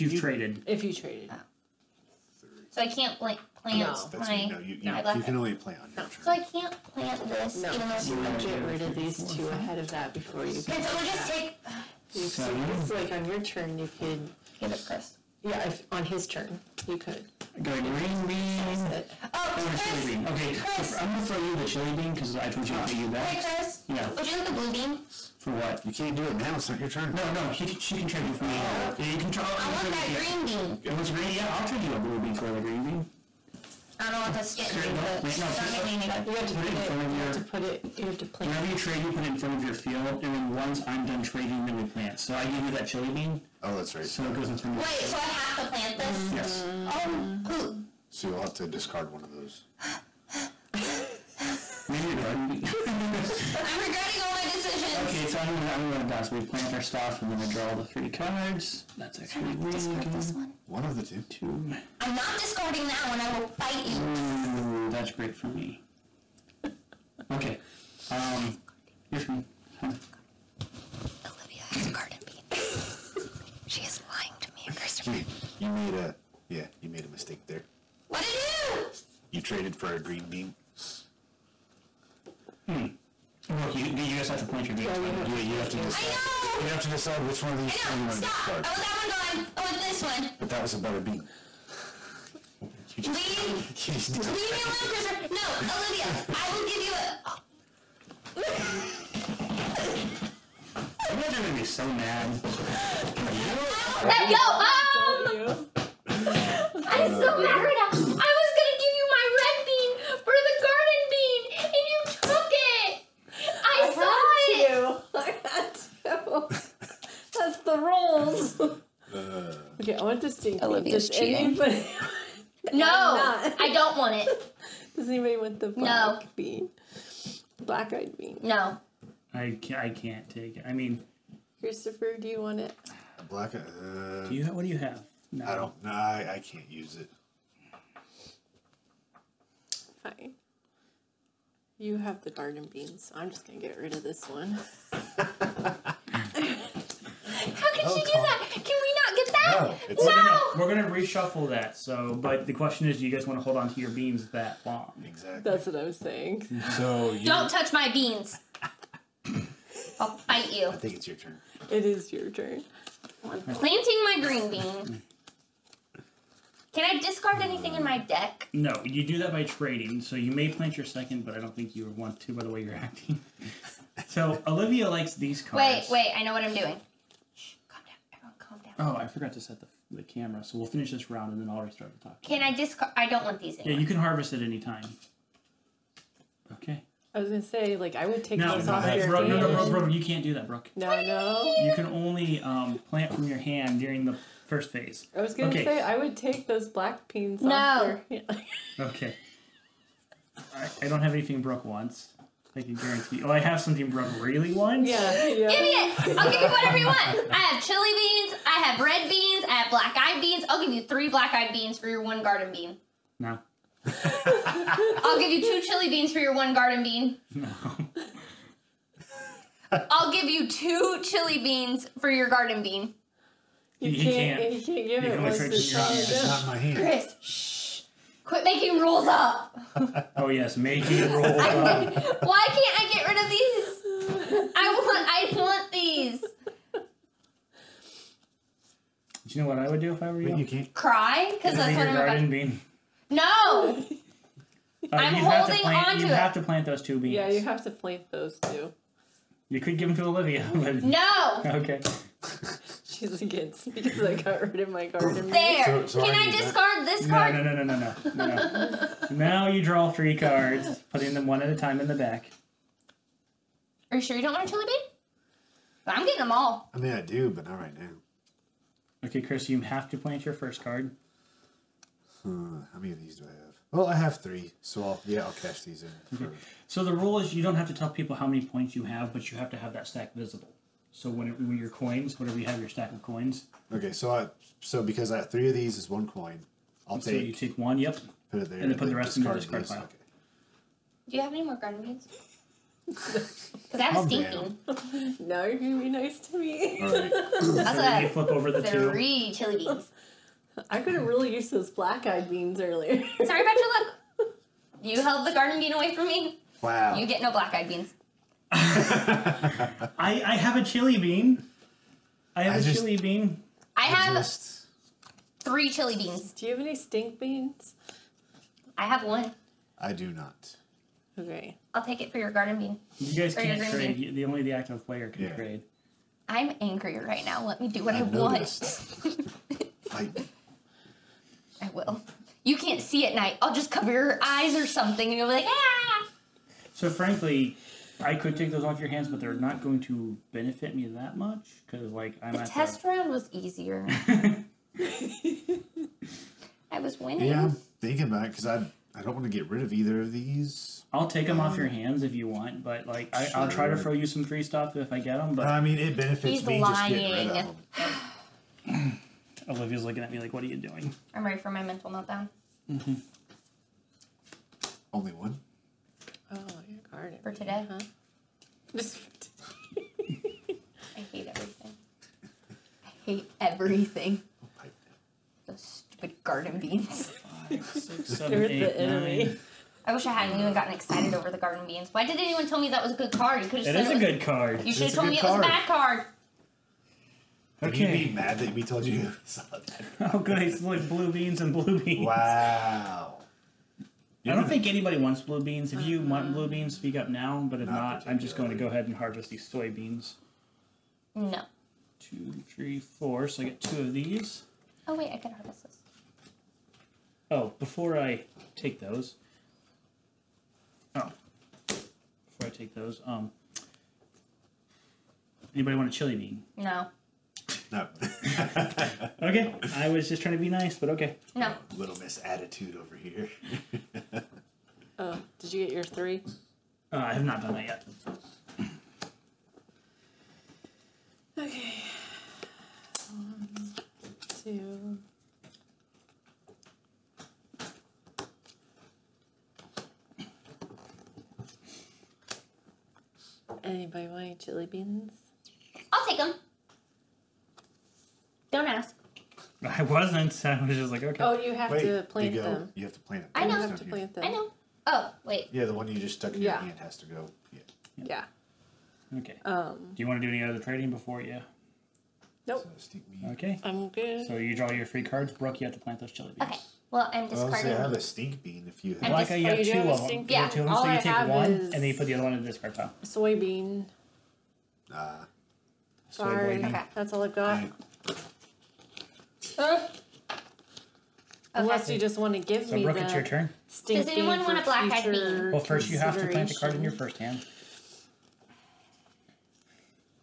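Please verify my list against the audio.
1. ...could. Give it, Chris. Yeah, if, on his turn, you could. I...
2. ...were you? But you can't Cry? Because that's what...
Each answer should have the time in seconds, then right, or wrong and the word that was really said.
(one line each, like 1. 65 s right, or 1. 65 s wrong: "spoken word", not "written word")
1. 13 s right
2. 240 s right.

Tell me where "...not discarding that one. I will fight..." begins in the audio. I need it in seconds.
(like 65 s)
62 s.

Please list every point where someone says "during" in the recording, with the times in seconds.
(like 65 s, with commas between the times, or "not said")
193 s.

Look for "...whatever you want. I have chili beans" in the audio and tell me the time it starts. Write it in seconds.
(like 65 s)
206 s.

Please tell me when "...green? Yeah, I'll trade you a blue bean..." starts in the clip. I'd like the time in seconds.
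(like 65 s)
31 s.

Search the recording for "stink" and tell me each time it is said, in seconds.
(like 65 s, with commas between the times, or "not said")
316 s, 467 s.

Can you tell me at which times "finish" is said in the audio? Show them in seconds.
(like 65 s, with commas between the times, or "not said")
180 s.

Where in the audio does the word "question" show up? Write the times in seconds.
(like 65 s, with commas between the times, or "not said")
152 s.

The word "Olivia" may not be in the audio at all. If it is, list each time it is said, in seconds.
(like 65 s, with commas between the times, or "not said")
71 s, 95 s, 120 s, 174 s, 250 s, 359 s.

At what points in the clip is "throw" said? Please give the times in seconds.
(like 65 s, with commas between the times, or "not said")
21 s, 353 s.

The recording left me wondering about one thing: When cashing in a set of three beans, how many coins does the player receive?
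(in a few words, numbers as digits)
1.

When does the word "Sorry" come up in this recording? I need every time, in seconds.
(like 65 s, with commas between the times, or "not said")
303 s, 476 s.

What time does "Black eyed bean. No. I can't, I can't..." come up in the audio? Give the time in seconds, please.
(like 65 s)
127 s.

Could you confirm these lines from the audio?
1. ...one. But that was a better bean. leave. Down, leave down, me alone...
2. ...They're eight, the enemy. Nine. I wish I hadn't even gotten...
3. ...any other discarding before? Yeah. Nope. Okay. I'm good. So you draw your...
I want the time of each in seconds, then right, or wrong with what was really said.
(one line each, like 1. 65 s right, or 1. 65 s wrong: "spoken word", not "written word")
1. 90 s right
2. 378 s right
3. 460 s wrong: "trading", not "discarding".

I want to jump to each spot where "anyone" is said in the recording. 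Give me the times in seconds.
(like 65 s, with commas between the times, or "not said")
382 s, 484 s.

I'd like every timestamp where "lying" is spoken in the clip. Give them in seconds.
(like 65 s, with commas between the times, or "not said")
74 s, 356 s.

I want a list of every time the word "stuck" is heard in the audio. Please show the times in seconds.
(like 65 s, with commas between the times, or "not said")
456 s.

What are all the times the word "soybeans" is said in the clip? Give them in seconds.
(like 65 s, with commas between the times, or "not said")
399 s, 473 s.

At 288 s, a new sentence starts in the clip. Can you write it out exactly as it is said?
And then put the rest in your discard pile.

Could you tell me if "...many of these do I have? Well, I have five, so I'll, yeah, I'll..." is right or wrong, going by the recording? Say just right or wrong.
wrong.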